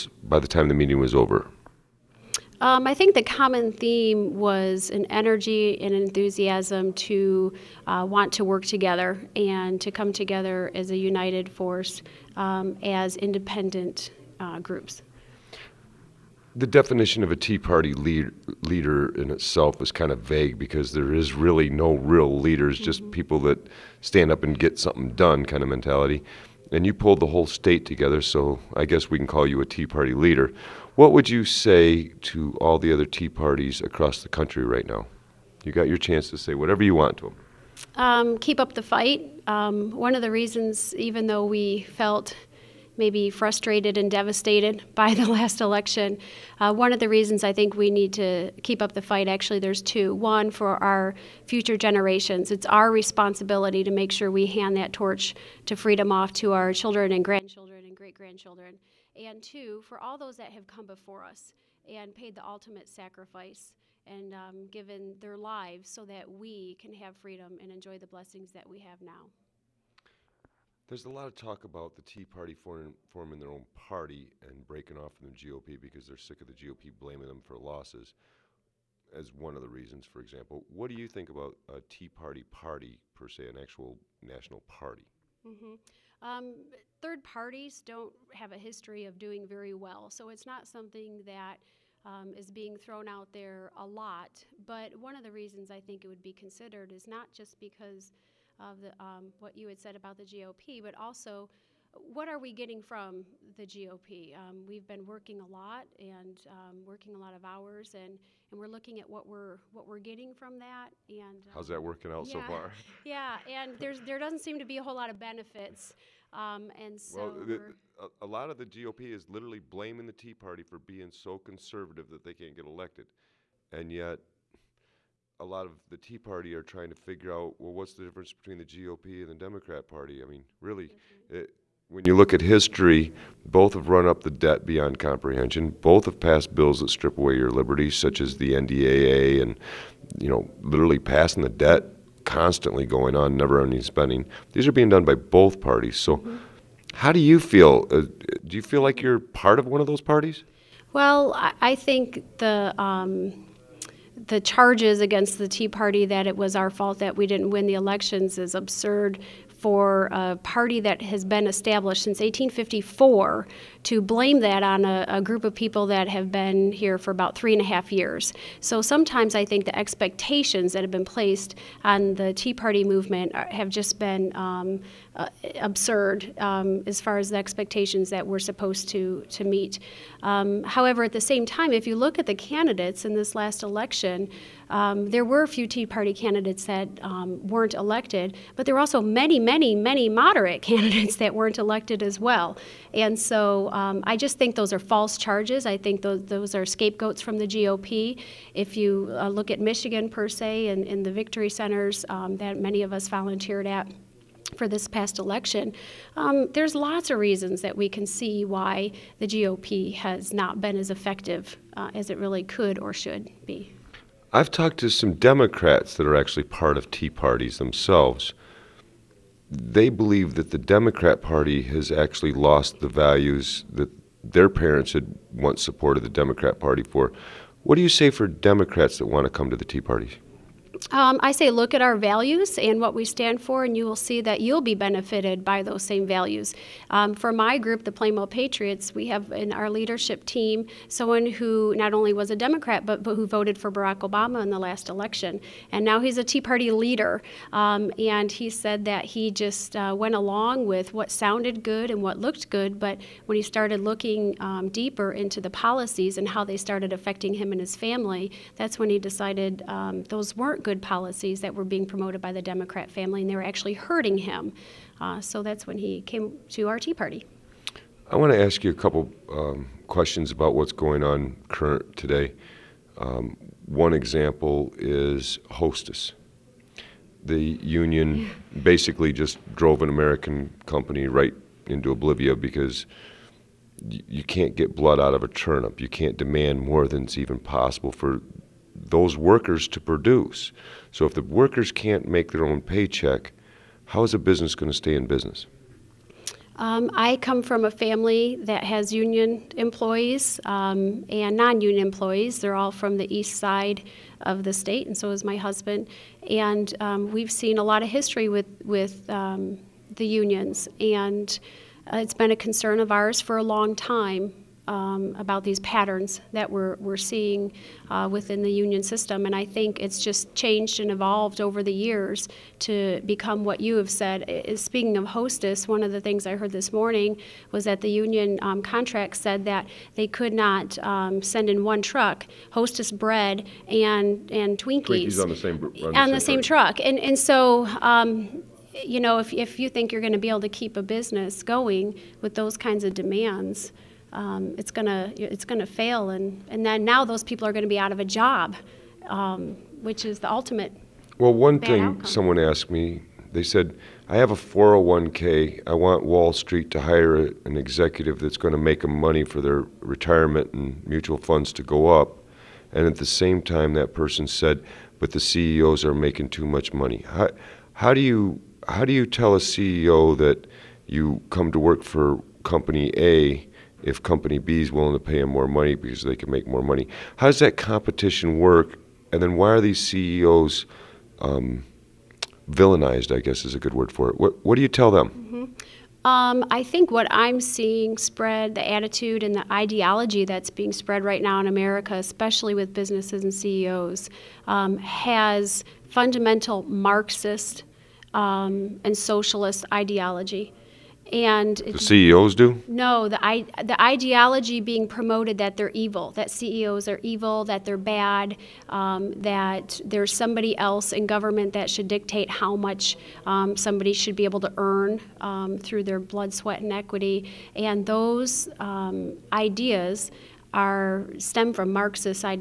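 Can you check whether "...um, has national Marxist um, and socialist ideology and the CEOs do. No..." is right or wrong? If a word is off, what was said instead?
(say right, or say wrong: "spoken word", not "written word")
wrong: "fundamental", not "national".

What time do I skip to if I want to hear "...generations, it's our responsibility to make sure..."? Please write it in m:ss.
0:51.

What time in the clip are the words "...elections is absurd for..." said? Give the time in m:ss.
2:37.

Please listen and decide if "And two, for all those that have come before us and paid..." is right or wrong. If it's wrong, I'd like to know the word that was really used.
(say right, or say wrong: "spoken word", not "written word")
right.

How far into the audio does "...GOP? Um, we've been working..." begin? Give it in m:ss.
1:43.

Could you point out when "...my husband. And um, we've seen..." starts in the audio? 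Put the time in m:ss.
5:05.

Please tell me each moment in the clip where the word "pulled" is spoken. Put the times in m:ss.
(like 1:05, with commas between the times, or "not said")
0:26.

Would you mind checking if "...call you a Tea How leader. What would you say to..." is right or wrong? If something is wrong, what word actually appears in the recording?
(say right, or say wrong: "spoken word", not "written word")
wrong: "Party", not "How".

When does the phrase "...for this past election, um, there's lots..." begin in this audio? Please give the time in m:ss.
3:24.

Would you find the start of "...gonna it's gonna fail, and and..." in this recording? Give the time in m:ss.
5:44.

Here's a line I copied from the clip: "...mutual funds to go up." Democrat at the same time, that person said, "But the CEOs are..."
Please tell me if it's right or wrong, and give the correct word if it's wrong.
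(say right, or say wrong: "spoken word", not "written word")
wrong: "And", not "Democrat".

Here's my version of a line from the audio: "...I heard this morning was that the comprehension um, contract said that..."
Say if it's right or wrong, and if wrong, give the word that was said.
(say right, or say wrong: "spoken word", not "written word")
wrong: "union", not "comprehension".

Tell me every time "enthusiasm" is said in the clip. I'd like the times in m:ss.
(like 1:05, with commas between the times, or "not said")
0:05.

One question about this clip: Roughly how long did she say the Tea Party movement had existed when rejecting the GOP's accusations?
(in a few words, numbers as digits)
three and a half years.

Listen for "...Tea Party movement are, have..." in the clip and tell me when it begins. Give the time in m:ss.
2:52.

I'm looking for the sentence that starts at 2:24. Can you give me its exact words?
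These are being done by both parties.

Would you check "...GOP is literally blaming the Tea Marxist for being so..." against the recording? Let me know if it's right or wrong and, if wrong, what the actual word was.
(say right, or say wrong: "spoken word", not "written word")
wrong: "Party", not "Marxist".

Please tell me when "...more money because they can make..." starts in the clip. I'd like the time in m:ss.
6:15.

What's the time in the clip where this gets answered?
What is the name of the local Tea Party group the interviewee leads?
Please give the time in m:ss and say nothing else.
3:57.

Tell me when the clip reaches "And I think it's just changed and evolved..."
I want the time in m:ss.
5:19.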